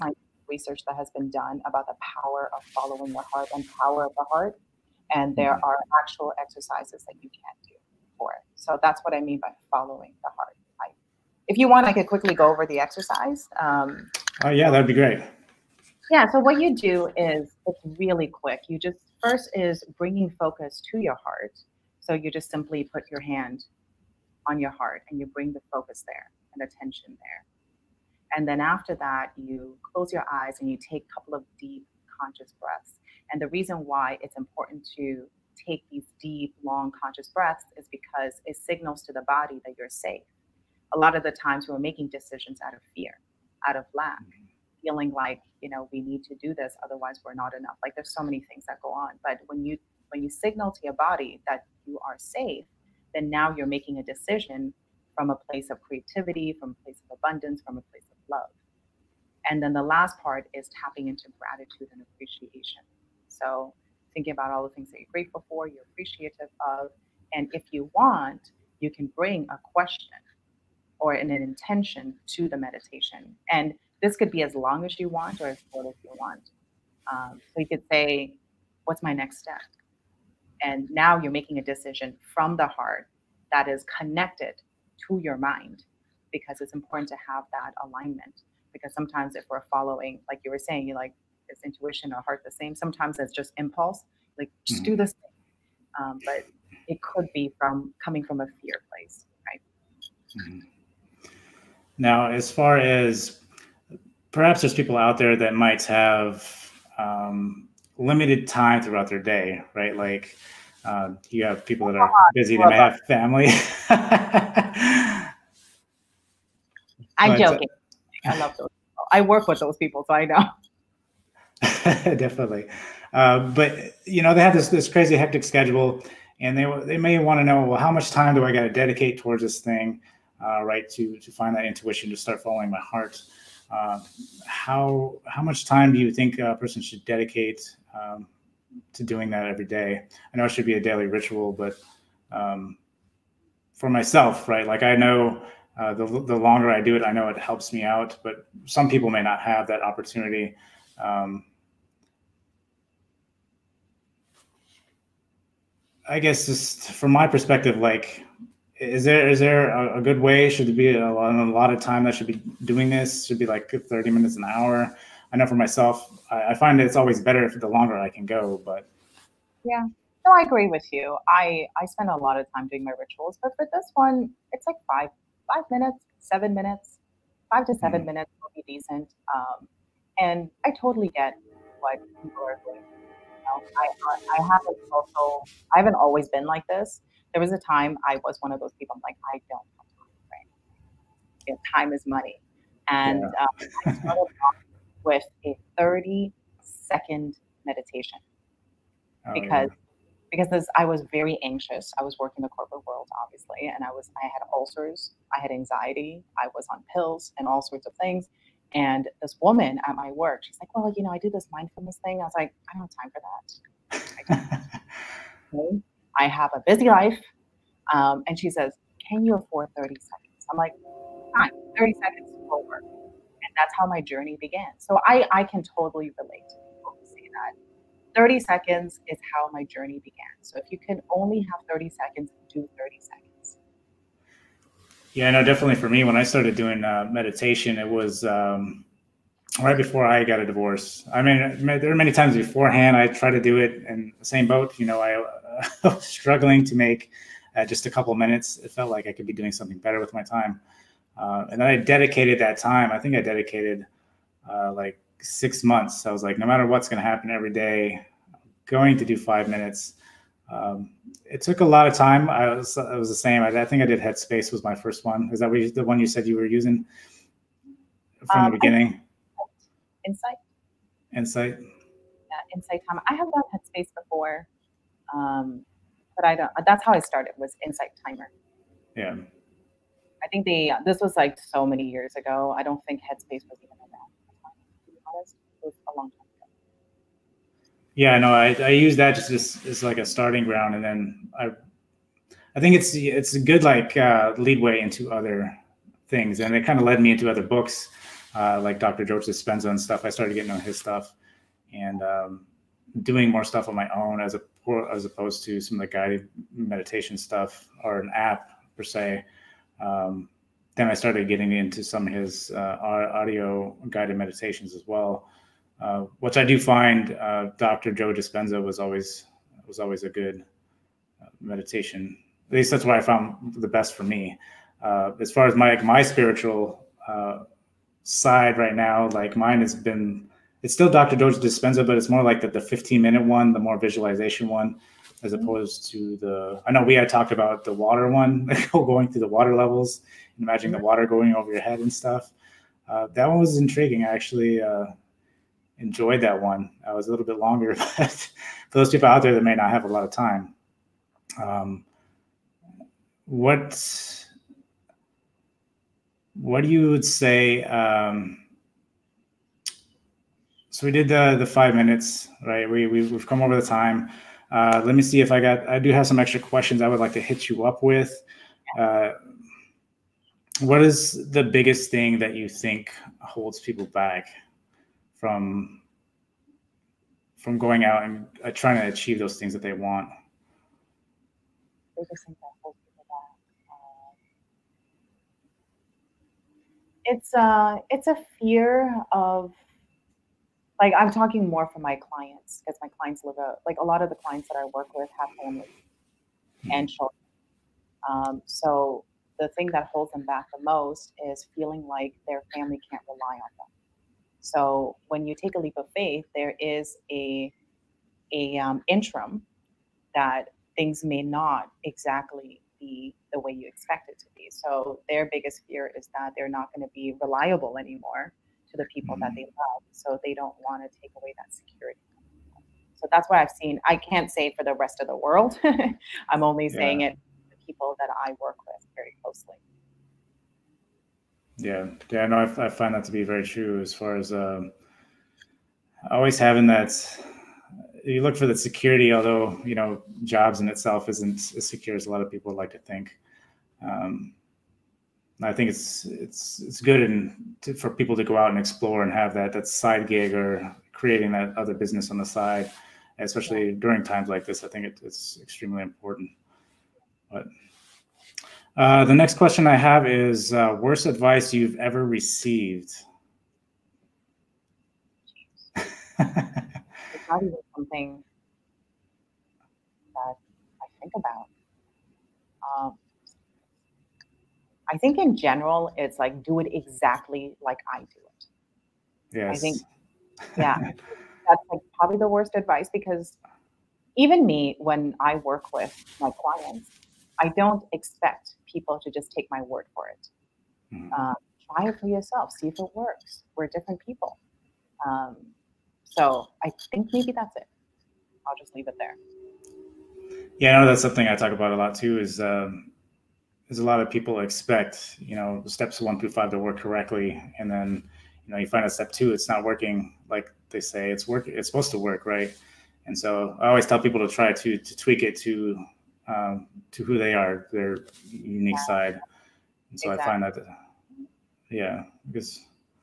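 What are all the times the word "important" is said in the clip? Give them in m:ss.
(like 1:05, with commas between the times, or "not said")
0:34, 1:26, 7:35.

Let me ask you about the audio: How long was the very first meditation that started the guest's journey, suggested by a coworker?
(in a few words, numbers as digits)
30 seconds.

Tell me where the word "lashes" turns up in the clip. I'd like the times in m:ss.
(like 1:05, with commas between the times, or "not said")
not said.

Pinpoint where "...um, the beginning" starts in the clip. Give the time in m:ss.
4:28.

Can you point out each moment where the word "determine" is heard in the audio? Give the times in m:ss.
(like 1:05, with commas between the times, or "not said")
not said.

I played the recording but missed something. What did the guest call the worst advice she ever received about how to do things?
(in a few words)
Do it exactly like I do.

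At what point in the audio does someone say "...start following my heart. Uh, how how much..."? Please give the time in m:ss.
2:12.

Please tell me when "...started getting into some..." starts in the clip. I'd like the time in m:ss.
5:10.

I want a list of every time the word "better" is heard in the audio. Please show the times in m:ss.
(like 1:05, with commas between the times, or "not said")
2:47, 4:09.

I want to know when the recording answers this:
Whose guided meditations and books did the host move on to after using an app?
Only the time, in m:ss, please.
5:17.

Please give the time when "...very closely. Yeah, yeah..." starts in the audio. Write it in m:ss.
7:08.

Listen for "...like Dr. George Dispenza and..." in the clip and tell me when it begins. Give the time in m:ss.
4:58.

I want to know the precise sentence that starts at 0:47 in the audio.
Like there's so many things that go on.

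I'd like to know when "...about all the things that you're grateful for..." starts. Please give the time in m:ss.
1:04.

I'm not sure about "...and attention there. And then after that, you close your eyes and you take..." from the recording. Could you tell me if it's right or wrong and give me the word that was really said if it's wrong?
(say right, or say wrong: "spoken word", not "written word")
right.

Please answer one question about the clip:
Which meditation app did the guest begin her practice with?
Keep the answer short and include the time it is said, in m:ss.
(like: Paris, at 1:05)
Insight Timer, at 4:37.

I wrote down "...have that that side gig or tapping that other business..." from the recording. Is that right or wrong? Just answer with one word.
wrong.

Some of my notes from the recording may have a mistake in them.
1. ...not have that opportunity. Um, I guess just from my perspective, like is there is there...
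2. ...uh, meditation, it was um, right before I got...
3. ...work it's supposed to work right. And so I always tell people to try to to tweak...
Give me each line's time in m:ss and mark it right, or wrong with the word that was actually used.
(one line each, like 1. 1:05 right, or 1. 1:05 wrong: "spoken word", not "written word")
1. 2:29 right
2. 3:56 right
3. 8:31 right.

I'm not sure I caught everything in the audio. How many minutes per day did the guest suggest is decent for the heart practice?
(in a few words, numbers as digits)
5 to 7 minutes.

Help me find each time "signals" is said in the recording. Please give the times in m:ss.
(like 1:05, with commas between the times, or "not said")
0:38, 0:50.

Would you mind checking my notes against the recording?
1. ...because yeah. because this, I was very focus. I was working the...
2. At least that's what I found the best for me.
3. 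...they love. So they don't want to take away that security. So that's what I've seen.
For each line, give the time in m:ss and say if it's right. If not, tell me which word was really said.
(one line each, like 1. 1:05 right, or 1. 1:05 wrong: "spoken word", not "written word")
1. 3:19 wrong: "anxious", not "focus"
2. 5:22 right
3. 6:59 right.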